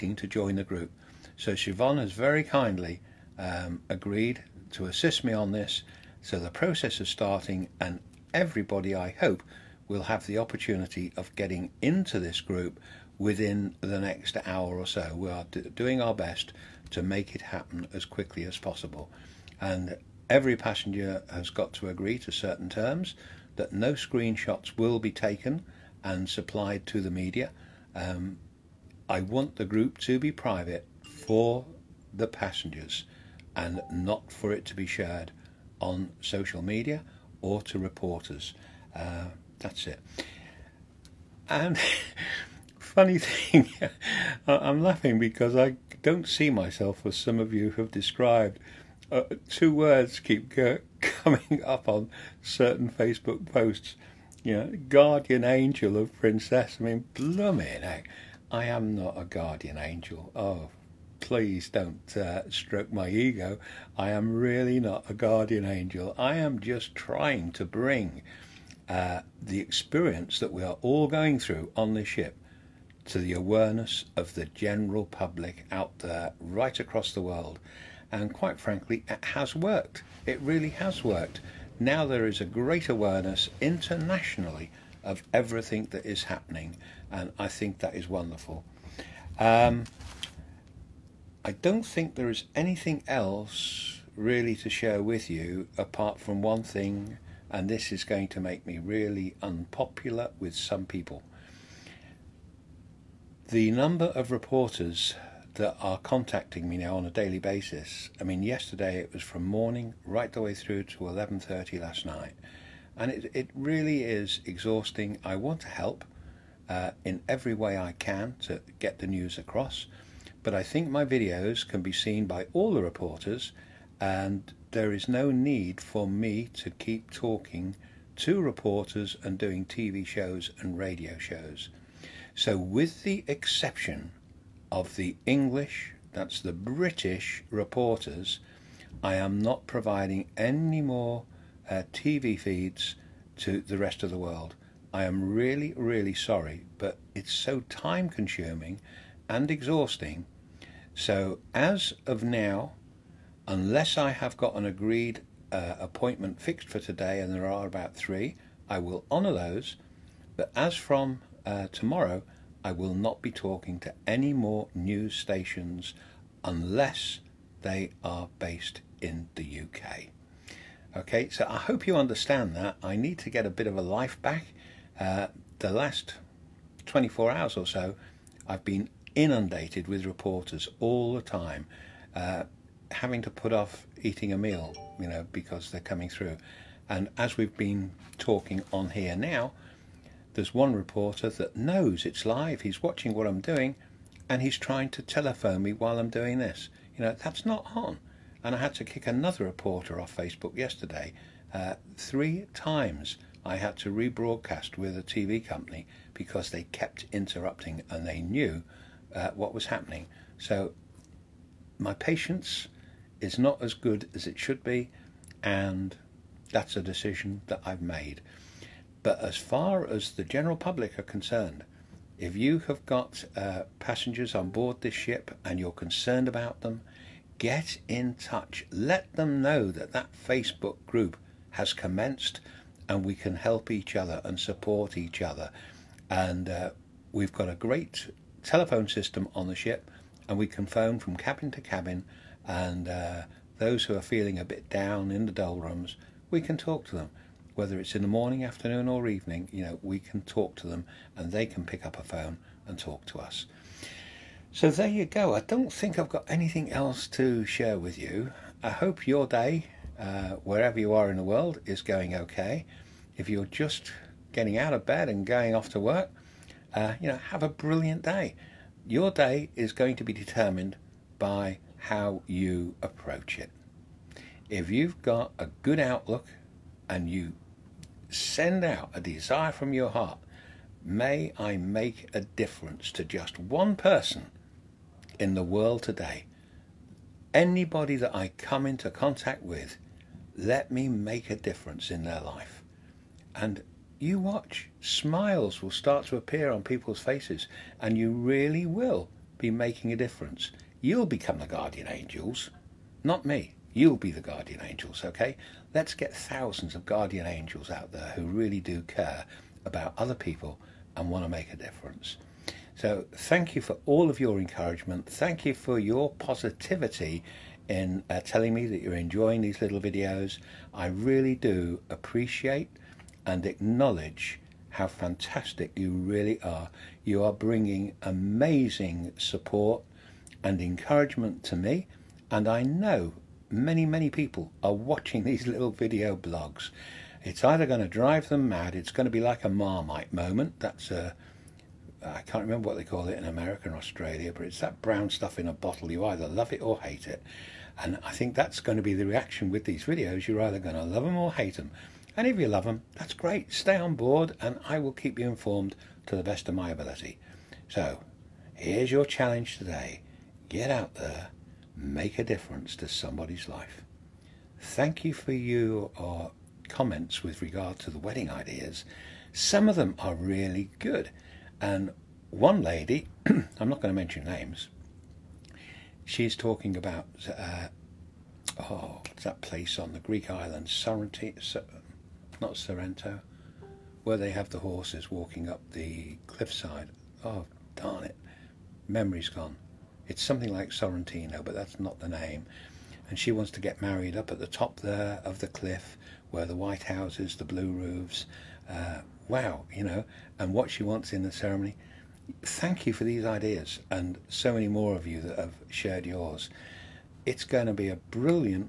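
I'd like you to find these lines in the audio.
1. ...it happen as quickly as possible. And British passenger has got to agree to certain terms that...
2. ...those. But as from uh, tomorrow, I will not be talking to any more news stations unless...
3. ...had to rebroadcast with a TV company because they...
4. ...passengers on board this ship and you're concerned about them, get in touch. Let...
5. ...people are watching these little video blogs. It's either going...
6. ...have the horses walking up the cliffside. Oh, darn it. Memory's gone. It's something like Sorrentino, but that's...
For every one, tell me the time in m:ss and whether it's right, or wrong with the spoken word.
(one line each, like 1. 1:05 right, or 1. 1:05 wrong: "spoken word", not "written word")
1. 0:17 wrong: "Every", not "British"
2. 2:39 right
3. 3:23 right
4. 3:43 right
5. 5:34 right
6. 6:24 right.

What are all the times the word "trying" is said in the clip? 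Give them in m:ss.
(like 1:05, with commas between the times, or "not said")
1:06, 3:14.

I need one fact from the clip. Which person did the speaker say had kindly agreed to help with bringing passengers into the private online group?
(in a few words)
Siobhan.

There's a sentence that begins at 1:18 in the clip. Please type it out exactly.
And quite frankly, it has worked.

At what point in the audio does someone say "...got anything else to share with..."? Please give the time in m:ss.
4:16.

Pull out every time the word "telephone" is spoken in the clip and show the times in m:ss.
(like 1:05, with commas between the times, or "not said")
3:15, 3:58.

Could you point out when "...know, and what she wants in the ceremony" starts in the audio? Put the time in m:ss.
6:39.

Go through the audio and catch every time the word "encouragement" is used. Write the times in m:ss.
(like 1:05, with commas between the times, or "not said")
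5:14, 5:30.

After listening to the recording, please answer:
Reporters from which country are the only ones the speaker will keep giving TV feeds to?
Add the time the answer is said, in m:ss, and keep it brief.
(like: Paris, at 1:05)
British, at 2:16.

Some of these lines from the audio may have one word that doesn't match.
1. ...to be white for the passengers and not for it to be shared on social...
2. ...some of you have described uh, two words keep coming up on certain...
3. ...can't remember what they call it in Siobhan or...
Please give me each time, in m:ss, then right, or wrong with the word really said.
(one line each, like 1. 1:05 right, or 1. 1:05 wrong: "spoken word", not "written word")
1. 0:29 wrong: "private", not "white"
2. 0:47 right
3. 5:42 wrong: "America", not "Siobhan".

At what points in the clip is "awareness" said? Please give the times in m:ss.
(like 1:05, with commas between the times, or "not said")
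1:13, 1:22.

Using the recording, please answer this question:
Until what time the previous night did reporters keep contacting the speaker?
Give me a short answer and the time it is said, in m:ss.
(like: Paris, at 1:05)
11:30, at 1:51.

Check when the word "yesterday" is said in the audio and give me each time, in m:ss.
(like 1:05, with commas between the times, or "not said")
1:48, 3:20.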